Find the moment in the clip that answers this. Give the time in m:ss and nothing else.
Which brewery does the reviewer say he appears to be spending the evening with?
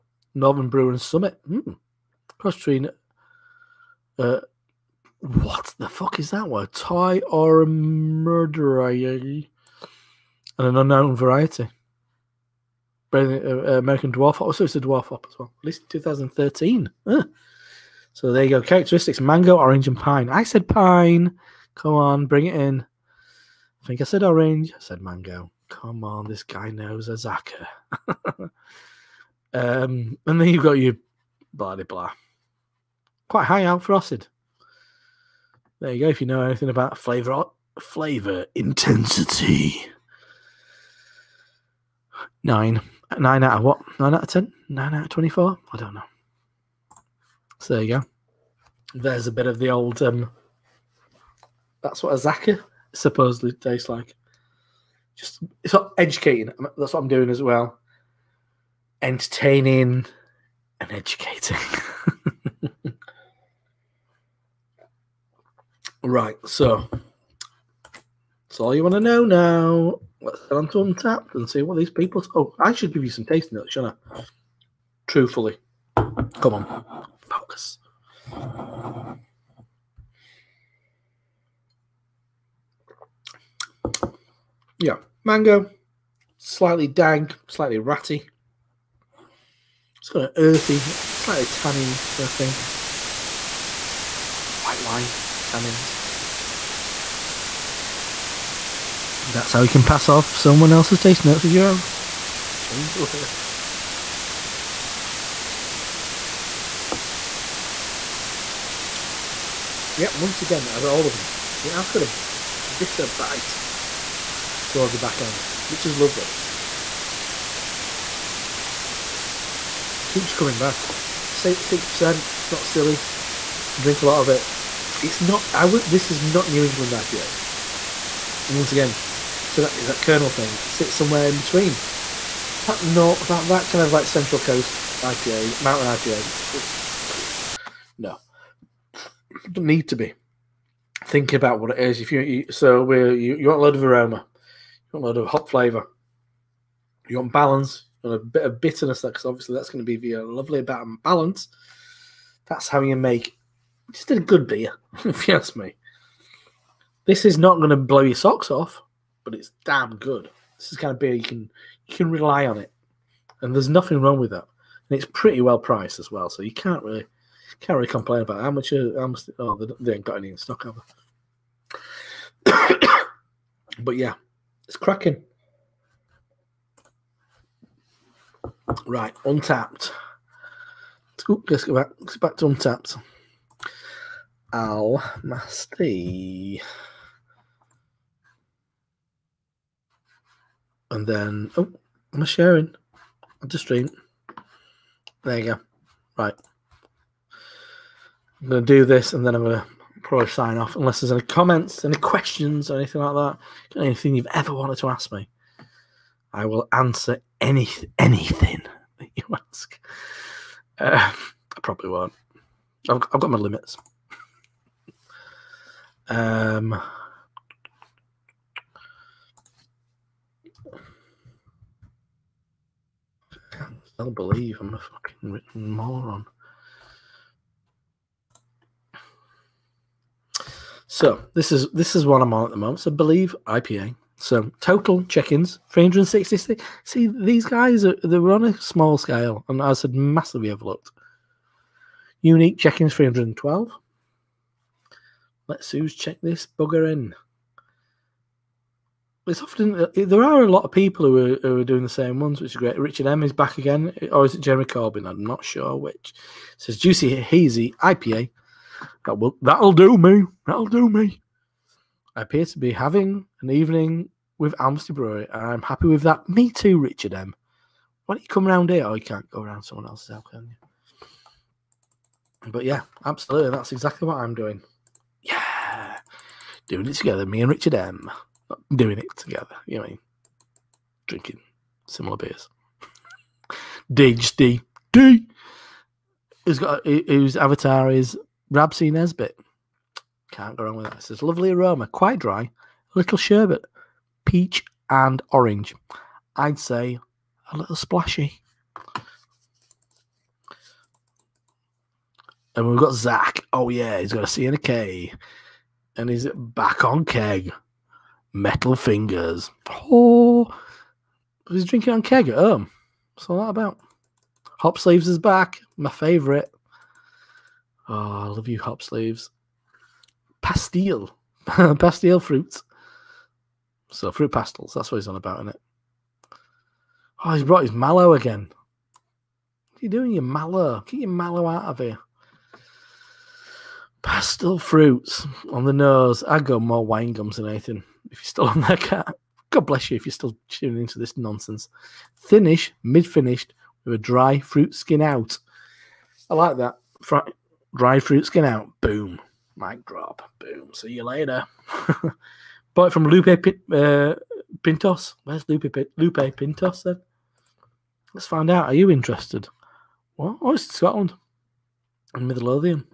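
4:24.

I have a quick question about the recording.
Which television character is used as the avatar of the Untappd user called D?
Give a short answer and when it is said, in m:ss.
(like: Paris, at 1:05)
Rab C. Nesbitt, at 4:48.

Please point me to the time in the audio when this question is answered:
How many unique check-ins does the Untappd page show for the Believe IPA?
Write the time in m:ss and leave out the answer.
4:02.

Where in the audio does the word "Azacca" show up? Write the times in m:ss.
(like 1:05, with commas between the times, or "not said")
0:27, 0:52.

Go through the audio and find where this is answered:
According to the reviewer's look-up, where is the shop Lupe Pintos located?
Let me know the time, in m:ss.
6:00.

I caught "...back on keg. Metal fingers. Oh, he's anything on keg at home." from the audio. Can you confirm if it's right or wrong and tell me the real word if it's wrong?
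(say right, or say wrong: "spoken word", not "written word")
wrong: "drinking", not "anything".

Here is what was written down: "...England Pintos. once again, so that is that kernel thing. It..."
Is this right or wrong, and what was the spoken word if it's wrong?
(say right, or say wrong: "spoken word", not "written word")
wrong: "IPA", not "Pintos".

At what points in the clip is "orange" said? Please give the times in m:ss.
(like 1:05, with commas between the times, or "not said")
0:19, 0:24, 4:55.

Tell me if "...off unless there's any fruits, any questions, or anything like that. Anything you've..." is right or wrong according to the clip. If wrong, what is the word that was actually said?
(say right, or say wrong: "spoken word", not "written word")
wrong: "comments", not "fruits".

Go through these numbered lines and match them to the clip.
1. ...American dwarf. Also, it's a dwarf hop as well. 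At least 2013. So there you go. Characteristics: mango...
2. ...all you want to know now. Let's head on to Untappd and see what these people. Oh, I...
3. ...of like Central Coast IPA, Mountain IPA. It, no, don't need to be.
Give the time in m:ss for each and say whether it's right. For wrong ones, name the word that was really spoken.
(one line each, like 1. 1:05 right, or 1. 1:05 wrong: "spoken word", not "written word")
1. 0:13 right
2. 1:08 right
3. 2:13 right.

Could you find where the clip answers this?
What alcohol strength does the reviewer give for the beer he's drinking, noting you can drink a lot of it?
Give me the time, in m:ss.
2:01.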